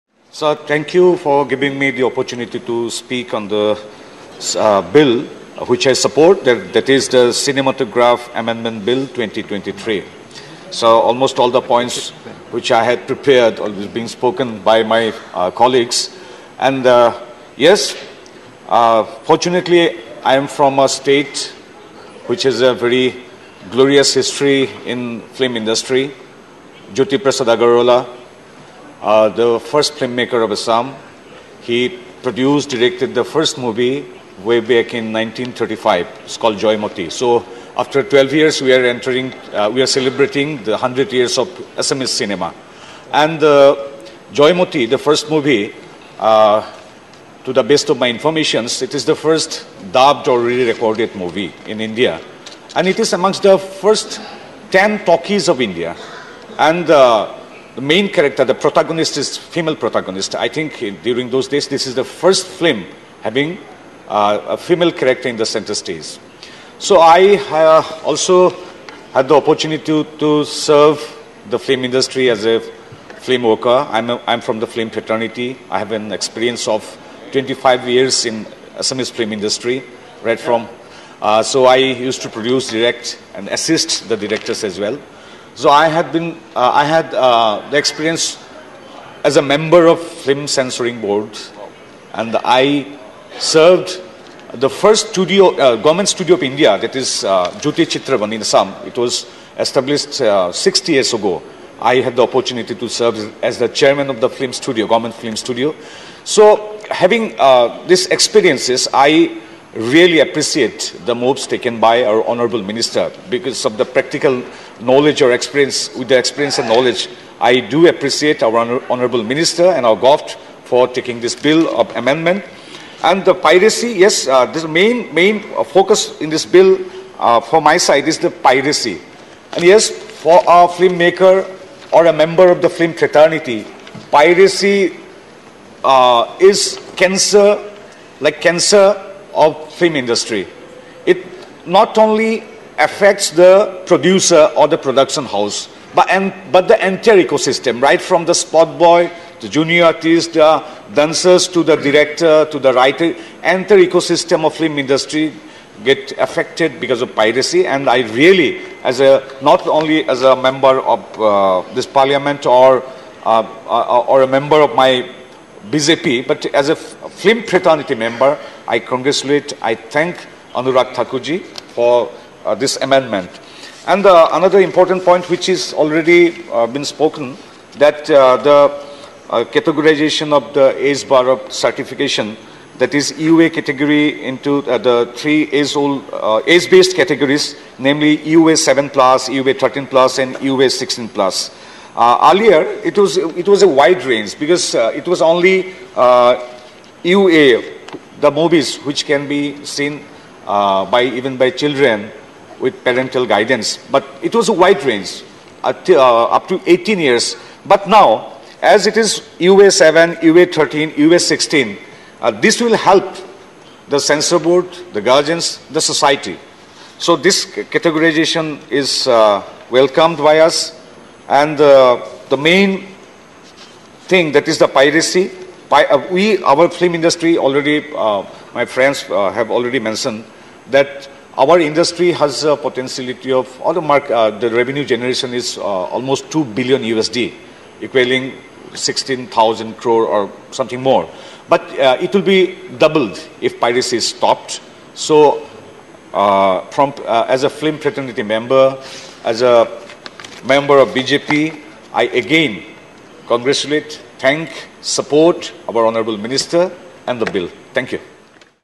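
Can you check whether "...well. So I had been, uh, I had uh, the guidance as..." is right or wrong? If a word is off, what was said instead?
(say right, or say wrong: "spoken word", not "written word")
wrong: "experience", not "guidance".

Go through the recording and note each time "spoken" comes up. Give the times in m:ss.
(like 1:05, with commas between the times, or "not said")
0:14, 2:56.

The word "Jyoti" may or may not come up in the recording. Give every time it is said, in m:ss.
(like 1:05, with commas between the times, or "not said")
0:26, 1:37.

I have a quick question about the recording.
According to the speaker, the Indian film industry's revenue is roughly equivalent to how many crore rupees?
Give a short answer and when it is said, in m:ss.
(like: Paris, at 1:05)
16,000 crore, at 3:58.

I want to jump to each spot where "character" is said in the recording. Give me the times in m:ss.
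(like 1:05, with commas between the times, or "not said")
0:58, 1:04.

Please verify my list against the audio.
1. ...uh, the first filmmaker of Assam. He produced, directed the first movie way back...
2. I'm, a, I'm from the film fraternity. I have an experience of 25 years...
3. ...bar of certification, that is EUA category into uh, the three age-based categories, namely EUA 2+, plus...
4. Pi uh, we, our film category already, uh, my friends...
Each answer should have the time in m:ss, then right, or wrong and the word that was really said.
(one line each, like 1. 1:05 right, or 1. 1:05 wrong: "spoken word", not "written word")
1. 0:29 right
2. 1:13 right
3. 3:01 wrong: "7", not "2"
4. 3:45 wrong: "industry", not "category".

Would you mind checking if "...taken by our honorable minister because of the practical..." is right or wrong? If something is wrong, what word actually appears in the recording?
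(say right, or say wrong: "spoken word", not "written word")
right.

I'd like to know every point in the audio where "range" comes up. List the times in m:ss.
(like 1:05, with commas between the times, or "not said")
3:14, 3:24.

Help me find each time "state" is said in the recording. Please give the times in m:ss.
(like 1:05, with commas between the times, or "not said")
0:20.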